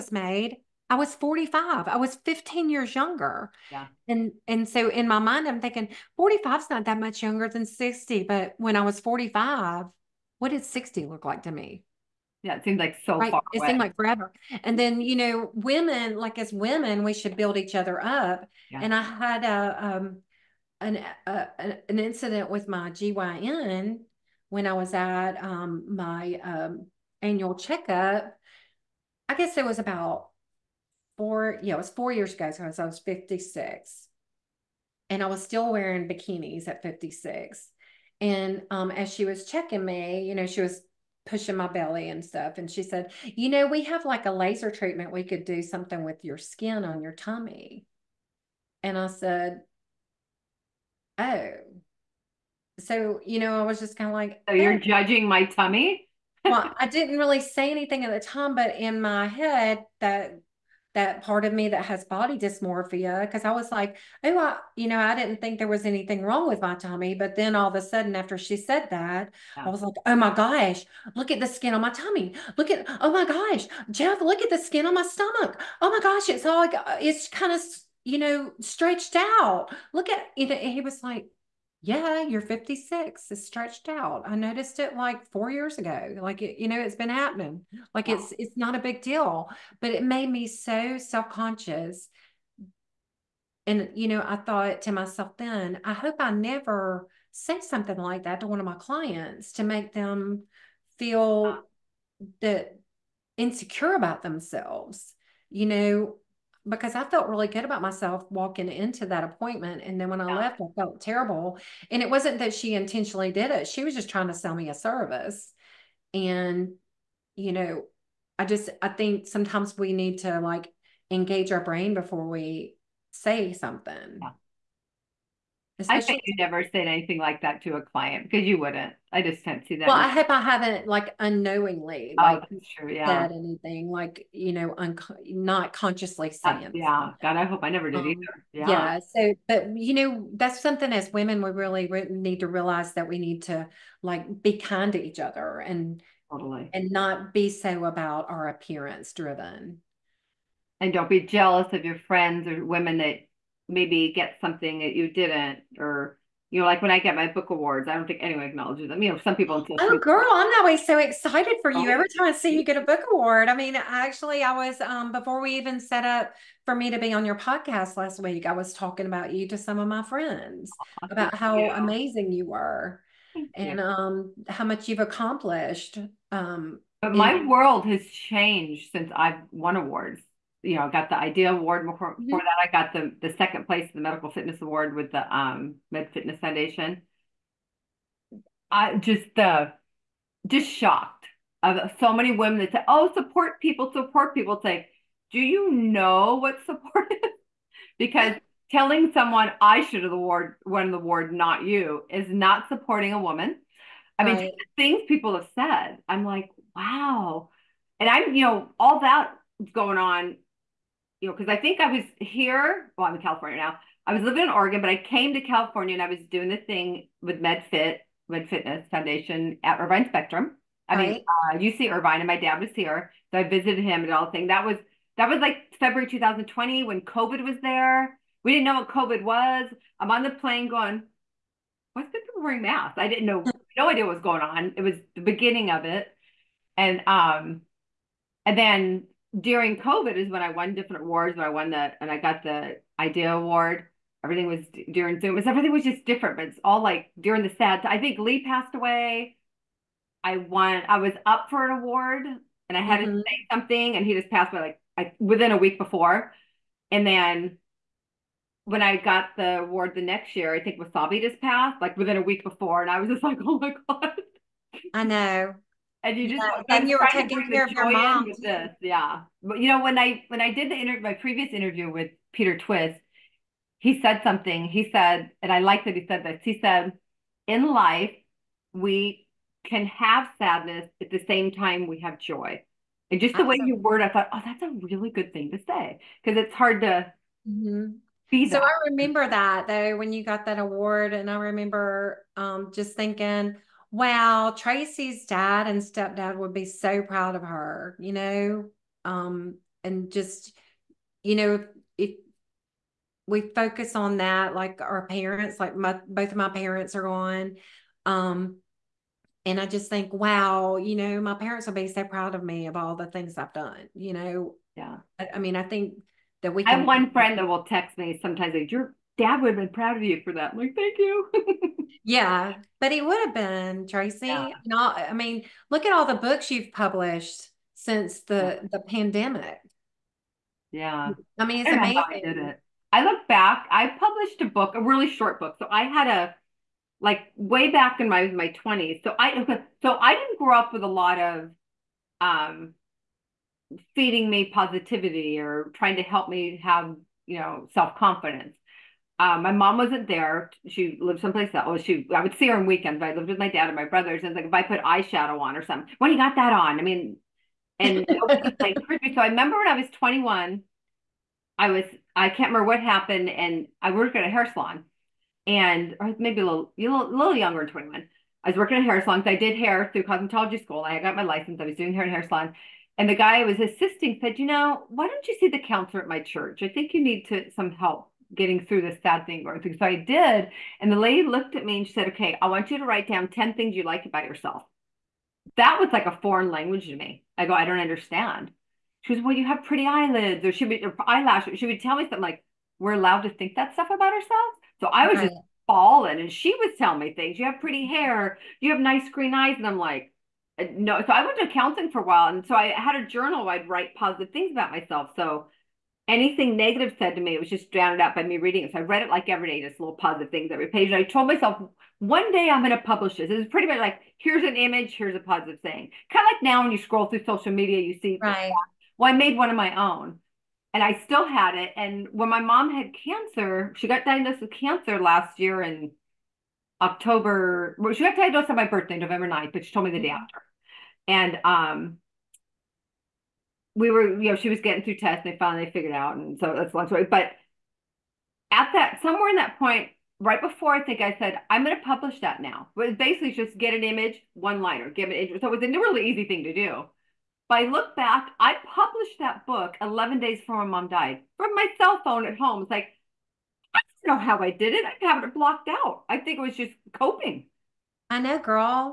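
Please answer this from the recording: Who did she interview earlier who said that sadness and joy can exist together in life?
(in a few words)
Peter Twist.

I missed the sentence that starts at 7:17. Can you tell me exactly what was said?
But at that, somewhere in that point, right before I think I said, I'm going to publish that now.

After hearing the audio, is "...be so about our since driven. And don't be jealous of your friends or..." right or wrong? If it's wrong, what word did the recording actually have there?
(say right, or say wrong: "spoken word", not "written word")
wrong: "appearance", not "since".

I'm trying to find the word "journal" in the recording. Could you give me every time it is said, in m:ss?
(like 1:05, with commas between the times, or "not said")
6:43.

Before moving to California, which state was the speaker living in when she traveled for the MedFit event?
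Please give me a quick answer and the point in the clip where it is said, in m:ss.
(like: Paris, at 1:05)
Oregon, at 3:34.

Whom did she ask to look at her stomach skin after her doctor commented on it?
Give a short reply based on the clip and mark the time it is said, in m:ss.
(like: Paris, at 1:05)
Jeff, at 1:13.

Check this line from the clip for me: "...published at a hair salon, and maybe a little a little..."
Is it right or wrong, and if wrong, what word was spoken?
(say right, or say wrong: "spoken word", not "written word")
wrong: "worked", not "published".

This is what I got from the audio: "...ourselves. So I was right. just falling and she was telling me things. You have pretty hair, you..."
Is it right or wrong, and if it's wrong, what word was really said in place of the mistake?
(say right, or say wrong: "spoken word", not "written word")
right.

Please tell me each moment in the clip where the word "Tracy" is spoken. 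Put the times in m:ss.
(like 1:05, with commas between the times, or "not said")
4:54, 5:23.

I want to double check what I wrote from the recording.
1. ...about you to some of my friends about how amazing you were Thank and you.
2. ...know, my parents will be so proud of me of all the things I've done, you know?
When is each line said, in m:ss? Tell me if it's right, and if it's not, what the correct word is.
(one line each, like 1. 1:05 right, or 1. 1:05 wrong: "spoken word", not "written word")
1. 2:49 right
2. 5:10 right.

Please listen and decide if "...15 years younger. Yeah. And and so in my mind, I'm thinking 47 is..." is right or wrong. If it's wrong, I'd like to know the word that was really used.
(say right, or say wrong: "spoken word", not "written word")
wrong: "45", not "47".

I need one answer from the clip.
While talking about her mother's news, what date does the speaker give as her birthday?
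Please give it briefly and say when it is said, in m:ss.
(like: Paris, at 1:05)
November 9, at 7:08.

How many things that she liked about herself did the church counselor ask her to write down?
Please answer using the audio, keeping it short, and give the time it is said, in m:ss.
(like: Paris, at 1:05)
10, at 6:23.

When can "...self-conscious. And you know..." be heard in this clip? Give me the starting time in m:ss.
1:30.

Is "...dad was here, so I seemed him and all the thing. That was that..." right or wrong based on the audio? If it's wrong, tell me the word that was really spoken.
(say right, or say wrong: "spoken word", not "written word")
wrong: "visited", not "seemed".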